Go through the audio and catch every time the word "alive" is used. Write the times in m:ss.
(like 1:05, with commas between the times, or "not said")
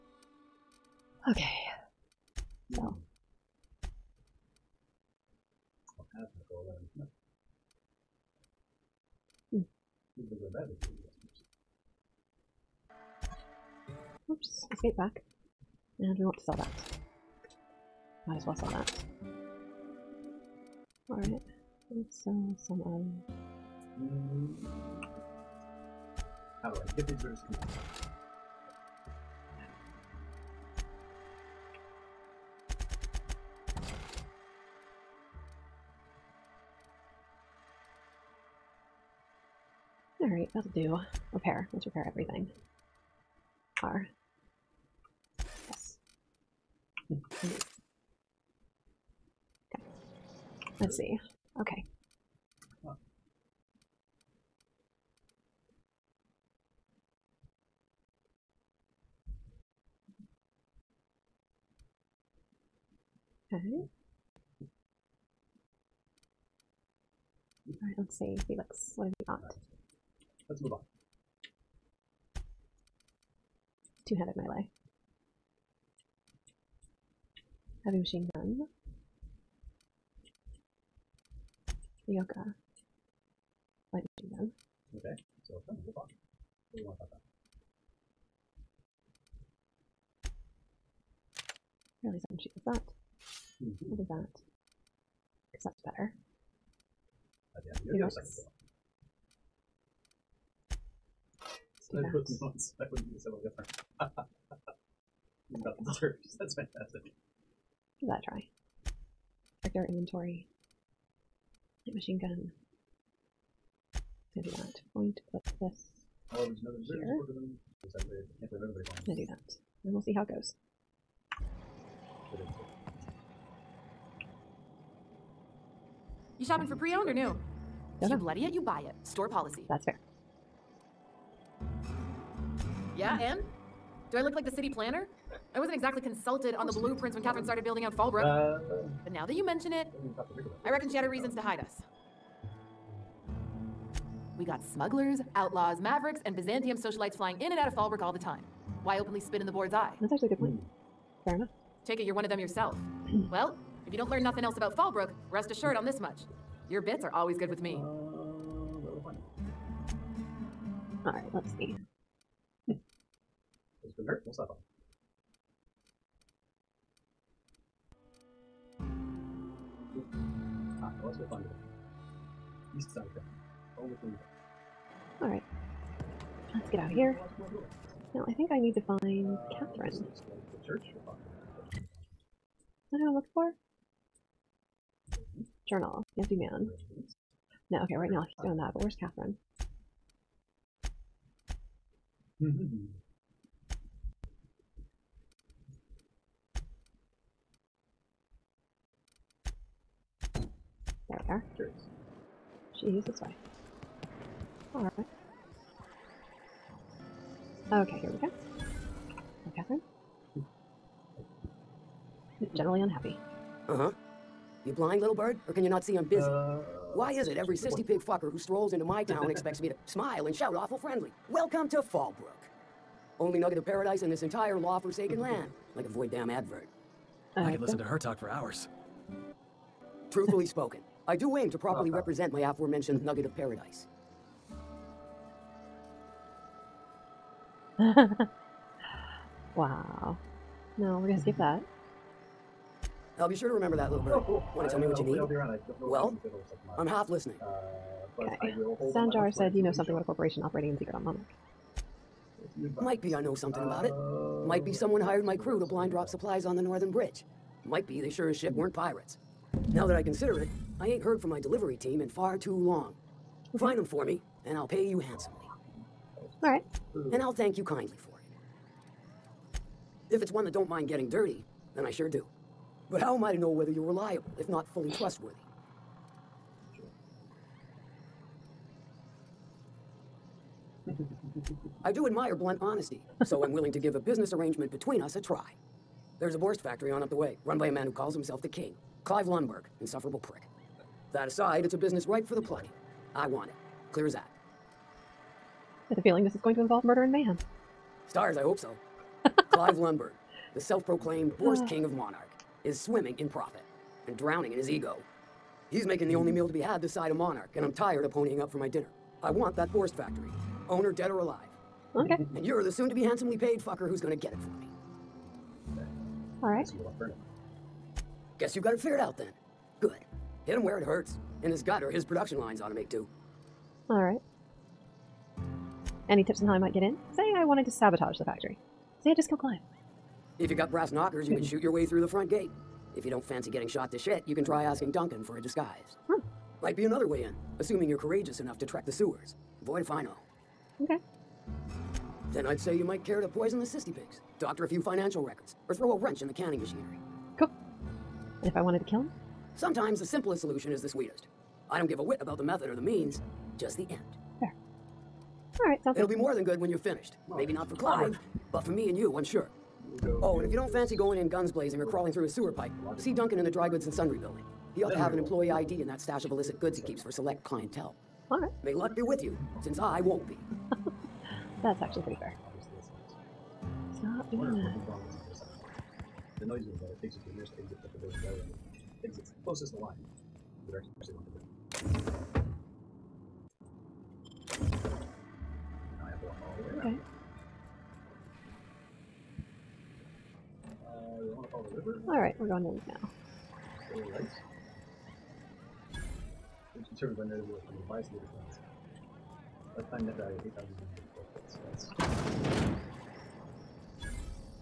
5:11.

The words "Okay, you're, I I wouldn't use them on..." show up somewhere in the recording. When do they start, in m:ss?
1:37.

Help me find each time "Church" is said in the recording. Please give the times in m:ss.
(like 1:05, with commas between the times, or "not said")
3:00.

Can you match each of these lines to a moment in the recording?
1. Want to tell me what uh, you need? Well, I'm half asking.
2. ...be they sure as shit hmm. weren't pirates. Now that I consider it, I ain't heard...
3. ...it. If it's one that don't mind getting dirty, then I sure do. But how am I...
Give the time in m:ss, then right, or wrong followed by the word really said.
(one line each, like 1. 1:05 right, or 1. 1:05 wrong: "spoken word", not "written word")
1. 4:04 wrong: "listening", not "asking"
2. 4:17 right
3. 4:29 right.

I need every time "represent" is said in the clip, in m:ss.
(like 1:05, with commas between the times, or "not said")
3:51.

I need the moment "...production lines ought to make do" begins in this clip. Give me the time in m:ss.
5:22.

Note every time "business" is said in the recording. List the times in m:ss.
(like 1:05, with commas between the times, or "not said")
4:43, 4:51.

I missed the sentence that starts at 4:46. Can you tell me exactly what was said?
There's a Borst factory on up the way, run by a man who calls himself the King.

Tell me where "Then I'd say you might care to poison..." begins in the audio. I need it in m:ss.
5:42.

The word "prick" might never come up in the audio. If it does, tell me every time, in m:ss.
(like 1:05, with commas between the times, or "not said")
4:50.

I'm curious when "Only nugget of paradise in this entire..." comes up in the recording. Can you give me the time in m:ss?
3:43.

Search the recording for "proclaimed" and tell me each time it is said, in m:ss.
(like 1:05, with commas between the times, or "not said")
5:00.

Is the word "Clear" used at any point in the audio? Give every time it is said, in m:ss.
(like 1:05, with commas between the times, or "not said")
4:53.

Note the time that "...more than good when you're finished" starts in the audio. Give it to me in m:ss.
5:56.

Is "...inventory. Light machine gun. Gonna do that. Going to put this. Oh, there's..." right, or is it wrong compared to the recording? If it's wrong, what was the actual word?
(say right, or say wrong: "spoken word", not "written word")
right.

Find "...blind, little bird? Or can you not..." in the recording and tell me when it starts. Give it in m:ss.
3:34.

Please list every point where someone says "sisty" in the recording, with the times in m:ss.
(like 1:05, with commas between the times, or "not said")
5:43.